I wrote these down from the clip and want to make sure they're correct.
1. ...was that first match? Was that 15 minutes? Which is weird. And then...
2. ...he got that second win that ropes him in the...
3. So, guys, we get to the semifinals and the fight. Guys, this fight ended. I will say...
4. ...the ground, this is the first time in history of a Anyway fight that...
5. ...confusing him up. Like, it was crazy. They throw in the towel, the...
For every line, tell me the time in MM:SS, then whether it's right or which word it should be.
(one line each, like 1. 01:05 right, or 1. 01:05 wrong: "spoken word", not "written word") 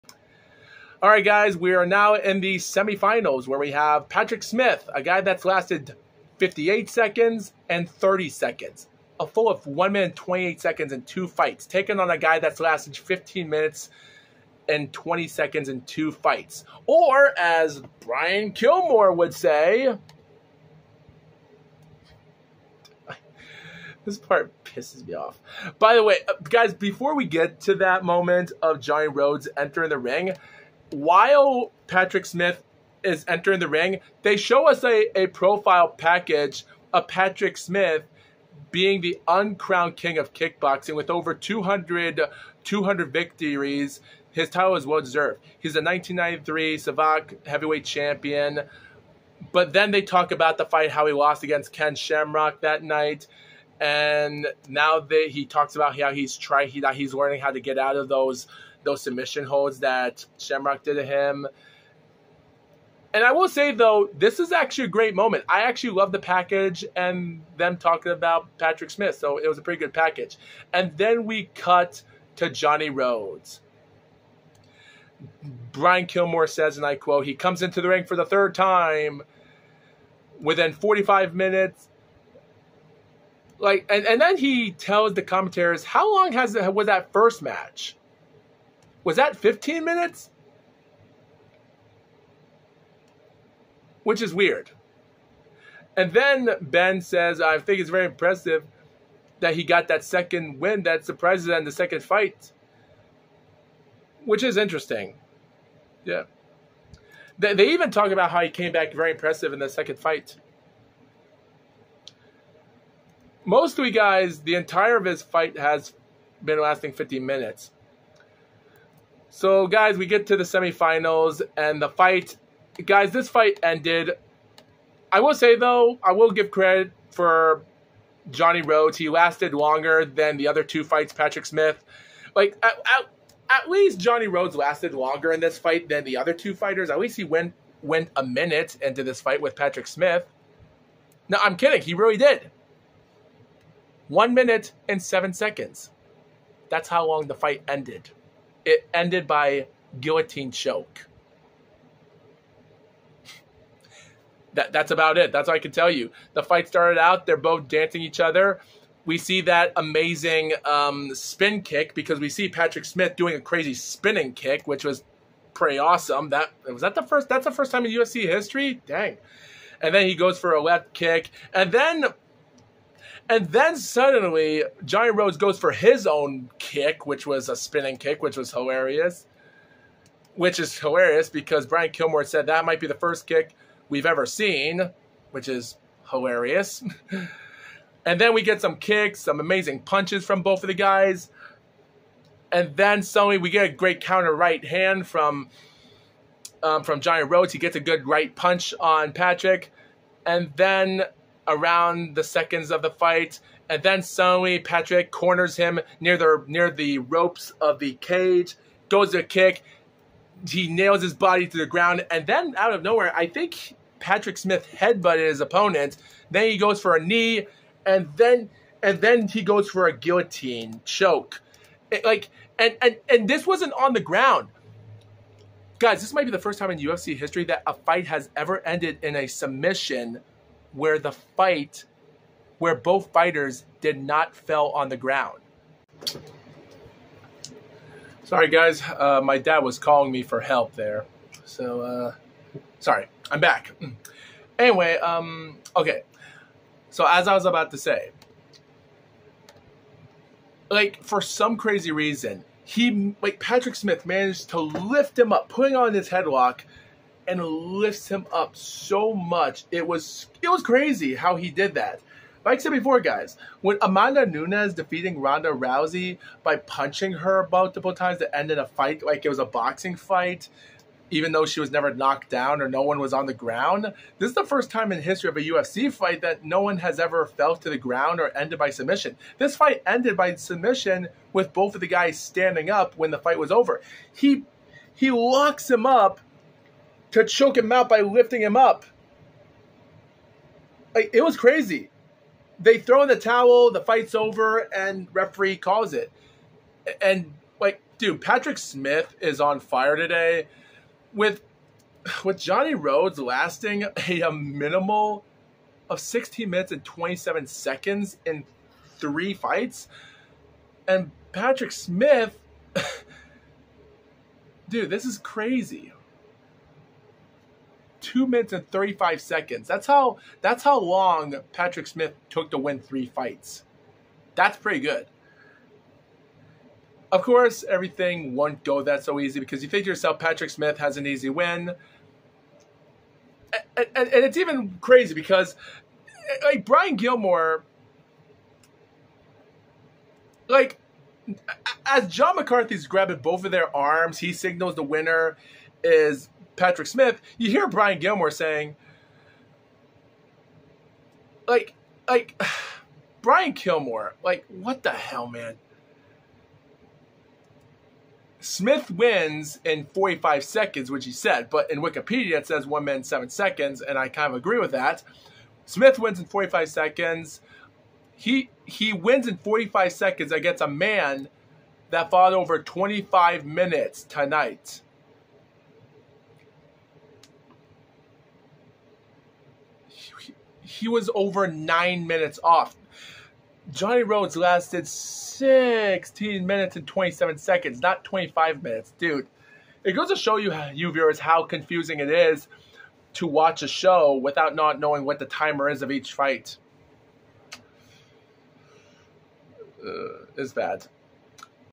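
1. 01:26 right
2. 01:39 wrong: "surprises", not "ropes"
3. 01:59 right
4. 04:33 wrong: "UFC", not "Anyway"
5. 04:48 wrong: "lifting", not "confusing".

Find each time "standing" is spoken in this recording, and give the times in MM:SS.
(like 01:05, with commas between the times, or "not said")
04:42.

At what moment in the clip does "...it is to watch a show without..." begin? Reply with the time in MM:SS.
06:31.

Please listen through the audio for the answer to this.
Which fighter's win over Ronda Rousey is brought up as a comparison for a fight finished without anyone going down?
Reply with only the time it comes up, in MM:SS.
04:23.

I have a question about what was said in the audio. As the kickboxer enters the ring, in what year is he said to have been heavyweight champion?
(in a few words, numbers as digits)
1993.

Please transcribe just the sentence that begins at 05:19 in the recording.
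That's how that's how long Patrick Smith took to win three fights.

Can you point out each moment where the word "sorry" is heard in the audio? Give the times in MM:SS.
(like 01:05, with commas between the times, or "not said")
03:58, 04:02.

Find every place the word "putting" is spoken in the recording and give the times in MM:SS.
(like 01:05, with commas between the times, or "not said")
04:15.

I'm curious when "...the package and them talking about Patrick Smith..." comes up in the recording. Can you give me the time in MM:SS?
01:06.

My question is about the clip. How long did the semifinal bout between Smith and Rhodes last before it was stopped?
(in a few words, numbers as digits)
1 minute 7 seconds.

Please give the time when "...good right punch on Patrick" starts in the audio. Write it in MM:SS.
03:17.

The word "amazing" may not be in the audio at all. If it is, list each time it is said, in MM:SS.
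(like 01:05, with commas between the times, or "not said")
02:39, 03:09.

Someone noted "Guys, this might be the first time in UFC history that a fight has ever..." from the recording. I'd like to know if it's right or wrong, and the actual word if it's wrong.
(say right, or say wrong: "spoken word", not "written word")
right.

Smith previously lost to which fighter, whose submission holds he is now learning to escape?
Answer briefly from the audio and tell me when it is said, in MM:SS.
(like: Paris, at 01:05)
Ken Shamrock, at 00:51.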